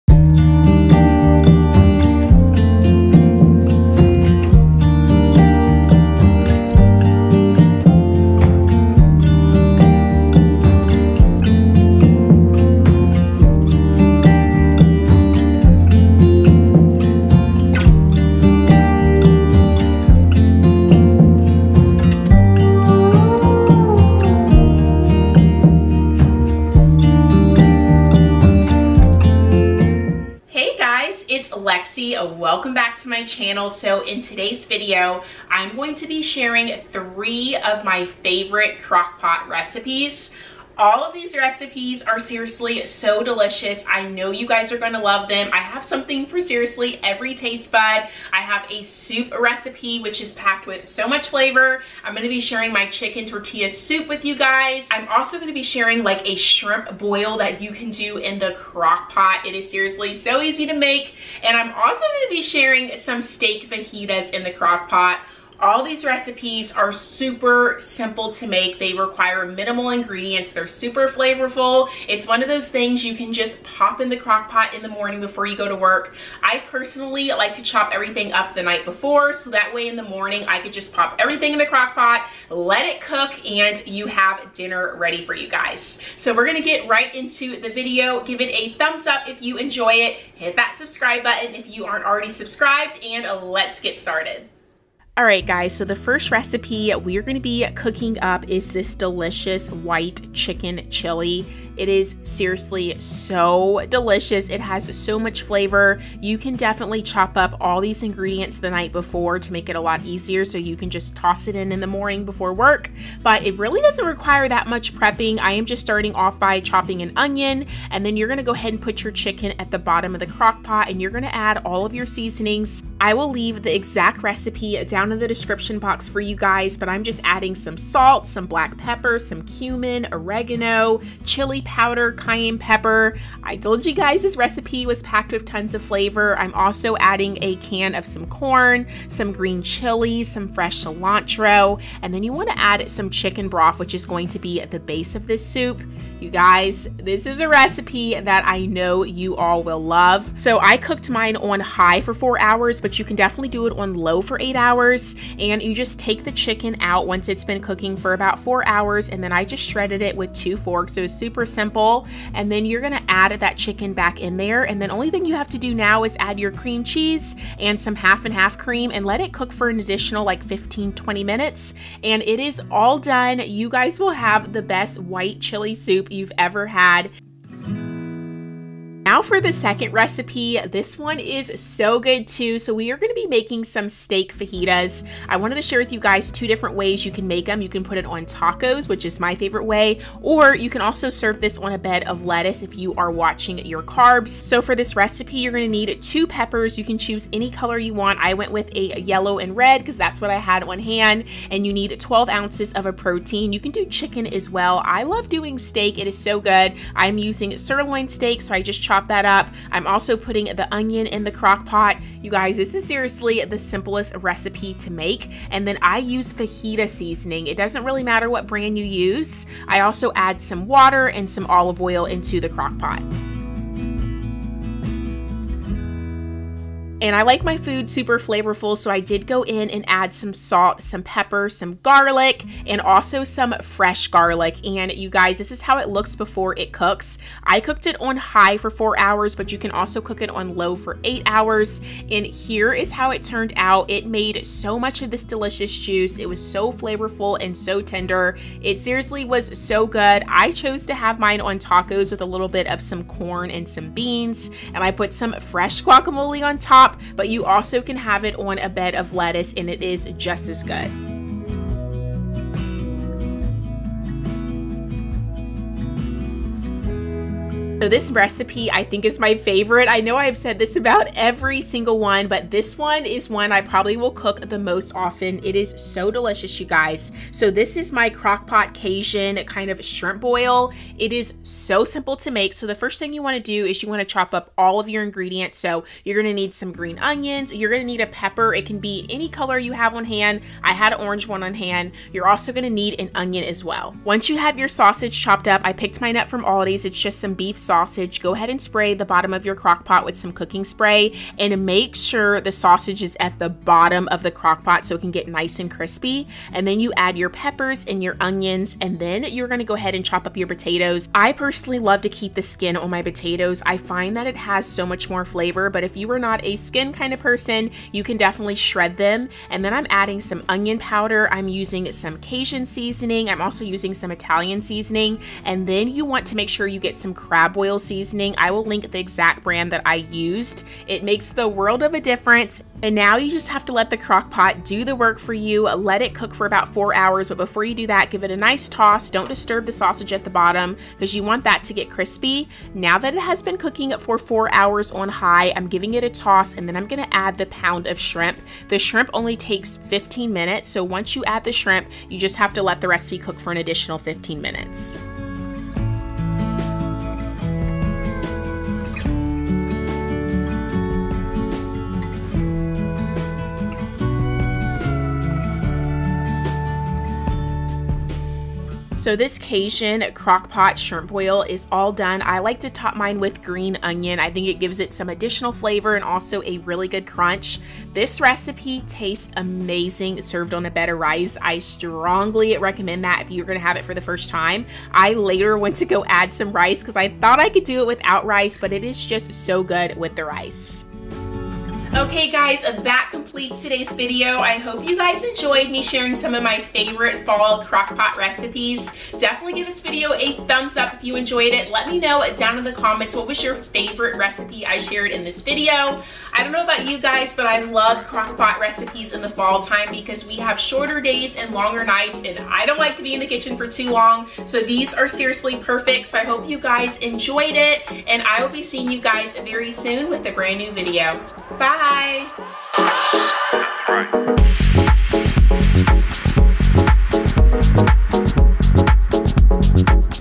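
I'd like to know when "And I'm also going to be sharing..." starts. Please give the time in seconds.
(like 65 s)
61 s.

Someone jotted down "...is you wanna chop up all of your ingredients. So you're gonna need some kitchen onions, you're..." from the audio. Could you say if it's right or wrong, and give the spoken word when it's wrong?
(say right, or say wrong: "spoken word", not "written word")
wrong: "green", not "kitchen".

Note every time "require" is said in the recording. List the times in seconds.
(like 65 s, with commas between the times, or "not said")
68 s, 114 s.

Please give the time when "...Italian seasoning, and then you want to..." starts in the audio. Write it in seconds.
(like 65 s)
324 s.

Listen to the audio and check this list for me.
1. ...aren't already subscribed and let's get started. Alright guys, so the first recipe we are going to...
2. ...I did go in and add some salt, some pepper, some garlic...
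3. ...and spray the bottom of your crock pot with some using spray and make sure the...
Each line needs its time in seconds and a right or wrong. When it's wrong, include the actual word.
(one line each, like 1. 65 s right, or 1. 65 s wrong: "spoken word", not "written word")
1. 91 s right
2. 228 s right
3. 298 s wrong: "cooking", not "using".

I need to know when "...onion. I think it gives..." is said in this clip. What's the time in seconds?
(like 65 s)
373 s.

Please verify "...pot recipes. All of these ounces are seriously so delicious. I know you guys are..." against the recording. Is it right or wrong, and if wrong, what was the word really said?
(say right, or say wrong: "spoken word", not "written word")
wrong: "recipes", not "ounces".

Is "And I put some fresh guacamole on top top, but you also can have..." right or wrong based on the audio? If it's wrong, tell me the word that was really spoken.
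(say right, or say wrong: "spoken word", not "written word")
right.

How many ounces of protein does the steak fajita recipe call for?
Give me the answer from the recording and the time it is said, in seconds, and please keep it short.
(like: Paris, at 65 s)
12 ounces, at 201 s.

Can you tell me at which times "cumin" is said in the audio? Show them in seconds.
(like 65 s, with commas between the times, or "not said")
129 s.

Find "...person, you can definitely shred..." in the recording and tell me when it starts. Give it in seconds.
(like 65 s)
317 s.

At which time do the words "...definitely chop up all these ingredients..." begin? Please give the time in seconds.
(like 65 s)
106 s.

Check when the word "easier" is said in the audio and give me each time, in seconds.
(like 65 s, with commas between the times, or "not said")
110 s.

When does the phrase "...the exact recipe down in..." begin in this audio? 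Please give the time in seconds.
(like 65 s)
123 s.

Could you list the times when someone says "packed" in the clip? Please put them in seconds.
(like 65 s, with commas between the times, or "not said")
50 s, 135 s.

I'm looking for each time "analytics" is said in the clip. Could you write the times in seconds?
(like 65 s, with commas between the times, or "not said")
not said.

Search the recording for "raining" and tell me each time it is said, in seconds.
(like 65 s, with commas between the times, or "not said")
not said.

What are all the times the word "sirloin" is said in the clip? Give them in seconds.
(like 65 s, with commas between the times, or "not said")
207 s.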